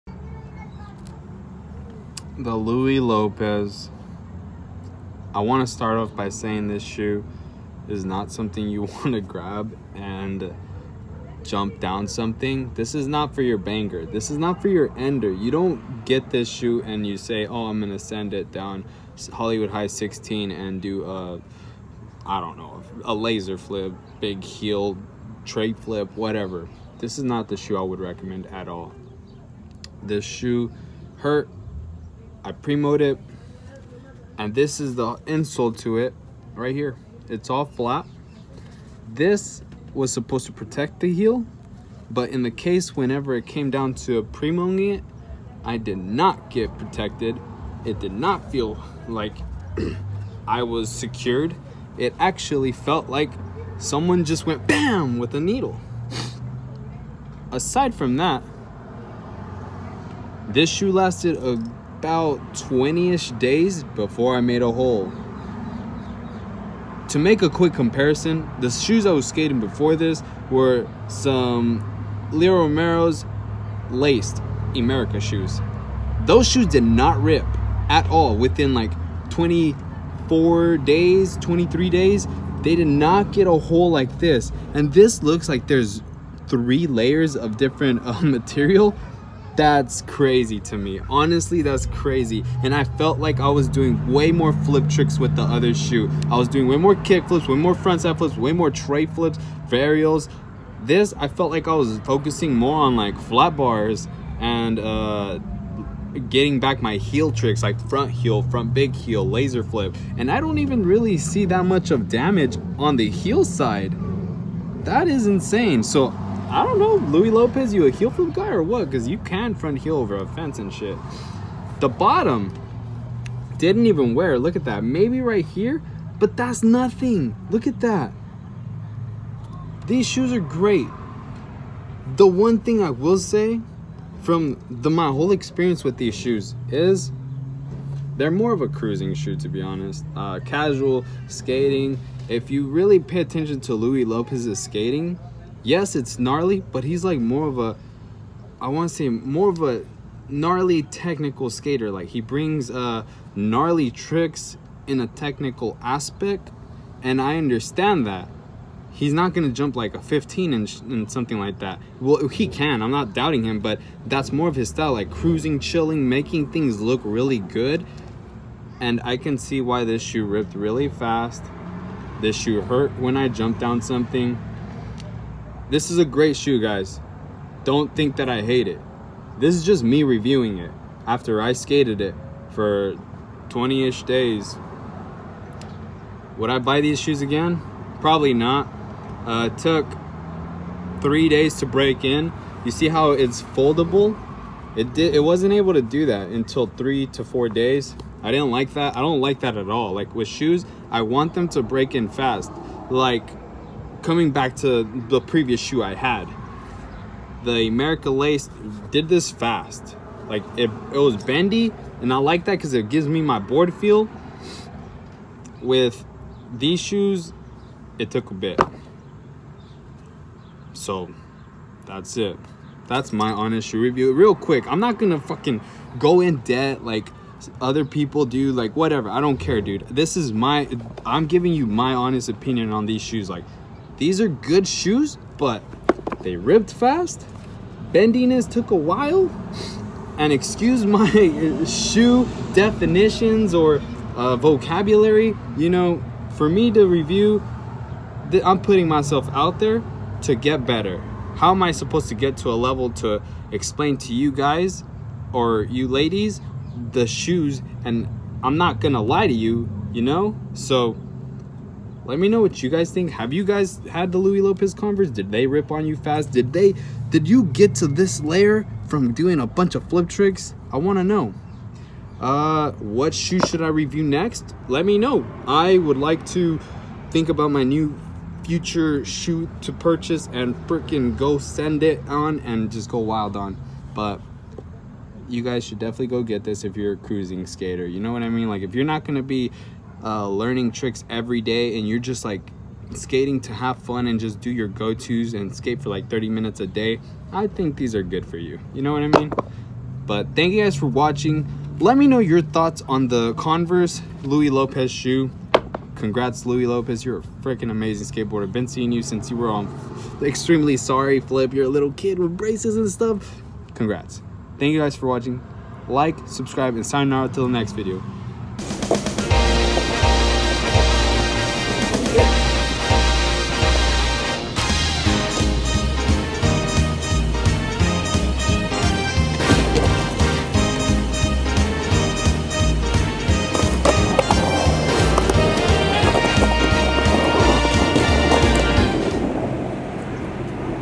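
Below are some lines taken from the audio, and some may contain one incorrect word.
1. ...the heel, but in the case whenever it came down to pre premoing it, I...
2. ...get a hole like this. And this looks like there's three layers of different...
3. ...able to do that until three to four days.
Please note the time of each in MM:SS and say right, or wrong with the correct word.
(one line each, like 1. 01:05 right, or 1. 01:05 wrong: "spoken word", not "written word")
1. 00:40 right
2. 01:23 right
3. 03:15 right.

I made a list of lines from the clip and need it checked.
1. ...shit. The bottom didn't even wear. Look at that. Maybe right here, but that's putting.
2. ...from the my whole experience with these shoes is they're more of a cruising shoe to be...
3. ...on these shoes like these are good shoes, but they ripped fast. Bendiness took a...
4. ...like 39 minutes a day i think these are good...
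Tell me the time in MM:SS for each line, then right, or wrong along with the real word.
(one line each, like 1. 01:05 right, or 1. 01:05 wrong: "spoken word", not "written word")
1. 02:00 wrong: "nothing", not "putting"
2. 02:14 right
3. 03:52 right
4. 04:55 wrong: "30", not "39".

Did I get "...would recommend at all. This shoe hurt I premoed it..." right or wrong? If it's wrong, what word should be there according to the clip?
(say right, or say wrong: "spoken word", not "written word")
right.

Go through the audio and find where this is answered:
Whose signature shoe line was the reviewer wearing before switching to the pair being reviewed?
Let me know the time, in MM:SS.
01:12.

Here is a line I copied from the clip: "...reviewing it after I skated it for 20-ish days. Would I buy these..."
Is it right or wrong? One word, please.
right.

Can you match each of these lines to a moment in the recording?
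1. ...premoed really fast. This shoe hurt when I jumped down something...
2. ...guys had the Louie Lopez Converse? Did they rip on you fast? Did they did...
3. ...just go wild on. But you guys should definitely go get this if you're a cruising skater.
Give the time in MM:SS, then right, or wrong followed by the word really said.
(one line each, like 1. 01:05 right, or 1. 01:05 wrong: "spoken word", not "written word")
1. 02:50 wrong: "ripped", not "premoed"
2. 04:23 right
3. 04:42 right.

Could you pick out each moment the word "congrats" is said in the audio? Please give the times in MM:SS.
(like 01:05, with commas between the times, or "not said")
05:05, 05:13.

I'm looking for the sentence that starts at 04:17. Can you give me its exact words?
And I'm not going to lie to you, you know?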